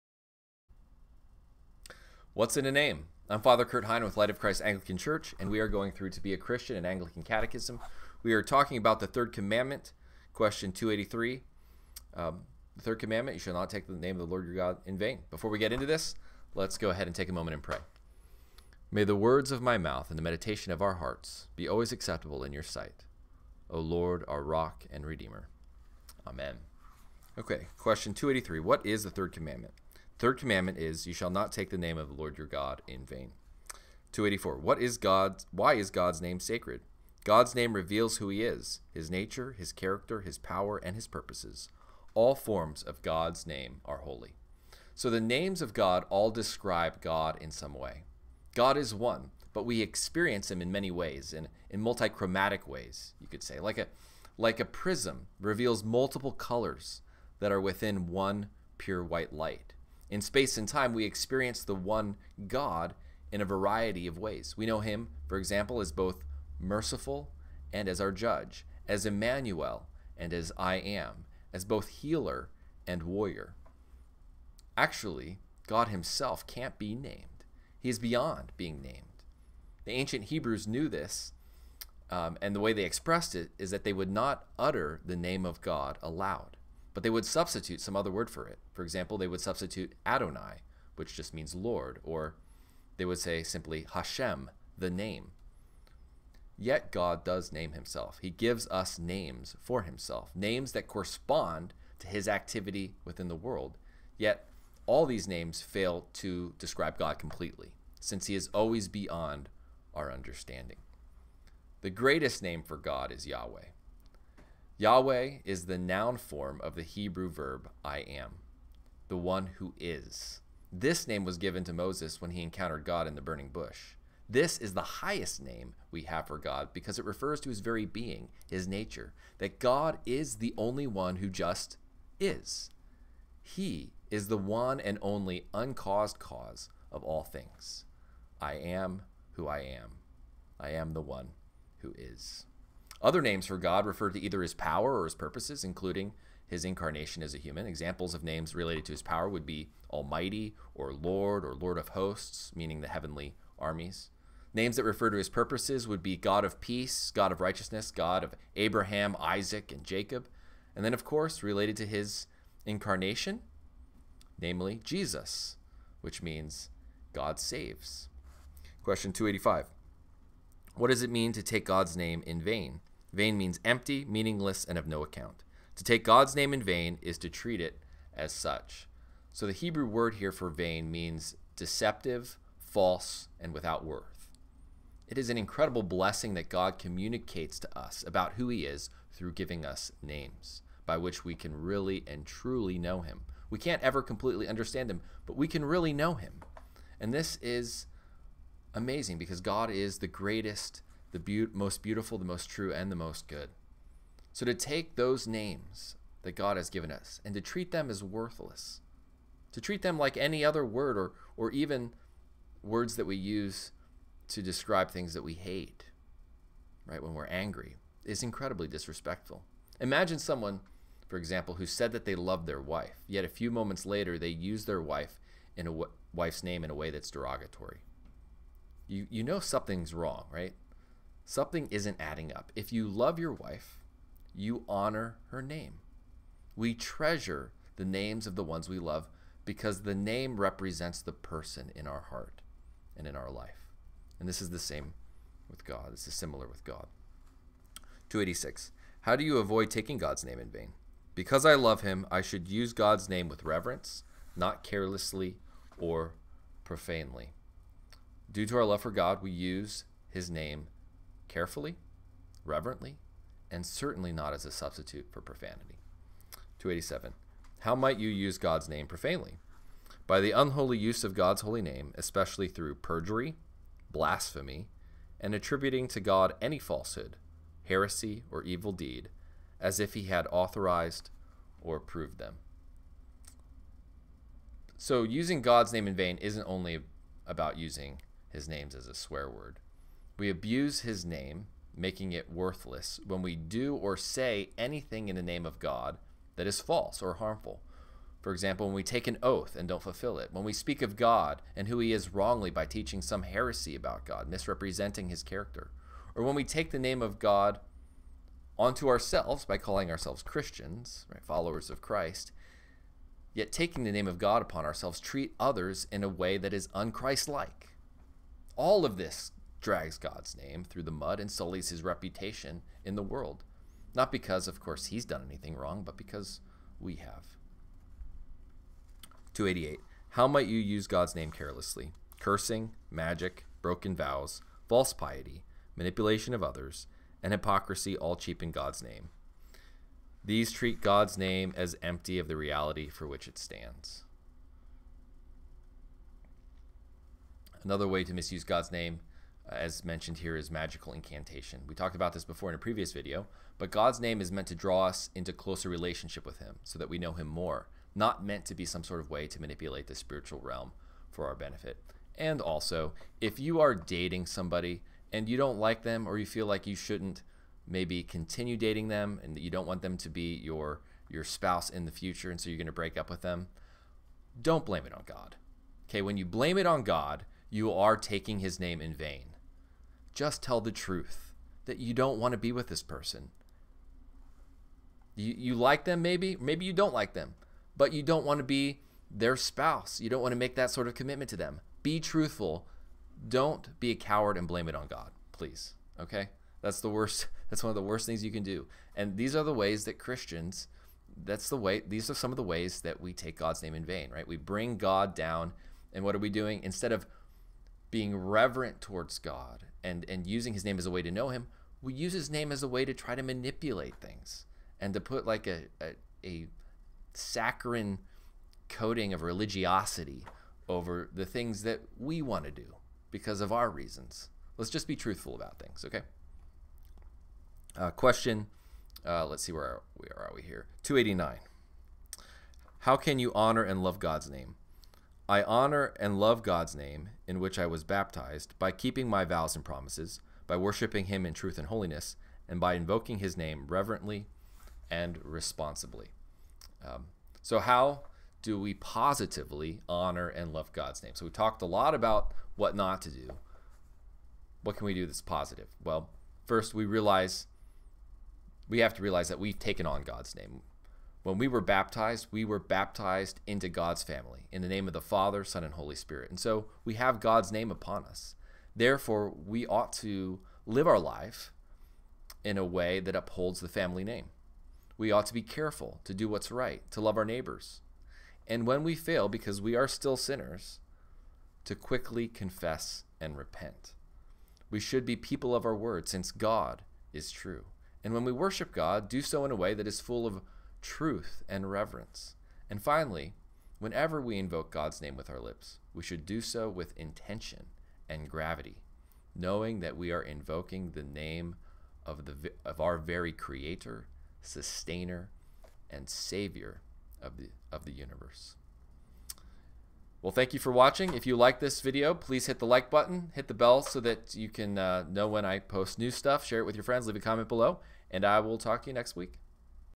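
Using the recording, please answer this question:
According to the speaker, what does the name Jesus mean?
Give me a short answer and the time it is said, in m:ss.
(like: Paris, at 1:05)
God saves, at 2:47.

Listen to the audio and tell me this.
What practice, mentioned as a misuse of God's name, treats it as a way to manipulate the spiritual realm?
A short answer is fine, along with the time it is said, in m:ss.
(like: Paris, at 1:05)
Magical incantation, at 5:50.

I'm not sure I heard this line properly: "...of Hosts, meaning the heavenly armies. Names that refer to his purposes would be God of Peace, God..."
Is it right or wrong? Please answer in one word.
right.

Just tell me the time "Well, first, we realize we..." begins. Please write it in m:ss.
7:35.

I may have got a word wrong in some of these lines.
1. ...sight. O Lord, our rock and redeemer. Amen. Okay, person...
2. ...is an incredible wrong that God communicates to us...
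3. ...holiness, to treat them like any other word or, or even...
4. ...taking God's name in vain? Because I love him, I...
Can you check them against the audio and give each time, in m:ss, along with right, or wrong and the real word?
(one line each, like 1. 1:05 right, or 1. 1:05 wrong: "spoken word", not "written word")
1. 0:22 wrong: "question", not "person"
2. 3:05 wrong: "blessing", not "wrong"
3. 3:28 wrong: "worthless", not "holiness"
4. 4:09 right.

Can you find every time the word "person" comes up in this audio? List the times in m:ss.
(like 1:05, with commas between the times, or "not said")
4:01, 6:22.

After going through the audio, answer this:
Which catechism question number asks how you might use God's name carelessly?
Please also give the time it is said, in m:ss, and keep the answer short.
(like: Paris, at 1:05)
288, at 5:29.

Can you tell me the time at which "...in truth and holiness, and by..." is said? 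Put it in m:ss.
7:21.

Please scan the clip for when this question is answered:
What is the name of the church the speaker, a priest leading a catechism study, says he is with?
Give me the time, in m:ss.
0:04.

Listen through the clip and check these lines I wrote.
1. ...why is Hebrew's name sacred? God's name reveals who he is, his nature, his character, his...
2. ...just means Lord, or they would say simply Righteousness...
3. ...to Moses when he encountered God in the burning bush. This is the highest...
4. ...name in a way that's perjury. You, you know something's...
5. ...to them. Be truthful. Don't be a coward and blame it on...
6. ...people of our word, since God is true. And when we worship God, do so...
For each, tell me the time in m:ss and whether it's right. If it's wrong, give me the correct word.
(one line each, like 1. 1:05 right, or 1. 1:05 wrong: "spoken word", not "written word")
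1. 0:35 wrong: "God", not "Hebrew"
2. 1:31 wrong: "Hashem", not "Righteousness"
3. 2:01 right
4. 3:46 wrong: "derogatory", not "perjury"
5. 6:31 right
6. 8:05 right.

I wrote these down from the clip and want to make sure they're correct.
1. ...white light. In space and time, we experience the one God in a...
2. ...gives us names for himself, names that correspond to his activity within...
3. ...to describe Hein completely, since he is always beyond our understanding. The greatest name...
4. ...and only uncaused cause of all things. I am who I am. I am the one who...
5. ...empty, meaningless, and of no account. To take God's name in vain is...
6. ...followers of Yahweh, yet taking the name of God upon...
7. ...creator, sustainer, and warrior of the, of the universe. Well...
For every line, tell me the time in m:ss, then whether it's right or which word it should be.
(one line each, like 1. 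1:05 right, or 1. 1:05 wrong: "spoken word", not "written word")
1. 0:59 right
2. 1:38 right
3. 1:46 wrong: "God", not "Hein"
4. 2:14 right
5. 2:53 right
6. 5:11 wrong: "Christ", not "Yahweh"
7. 8:23 wrong: "savior", not "warrior".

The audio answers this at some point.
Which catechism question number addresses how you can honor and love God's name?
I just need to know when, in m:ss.
7:10.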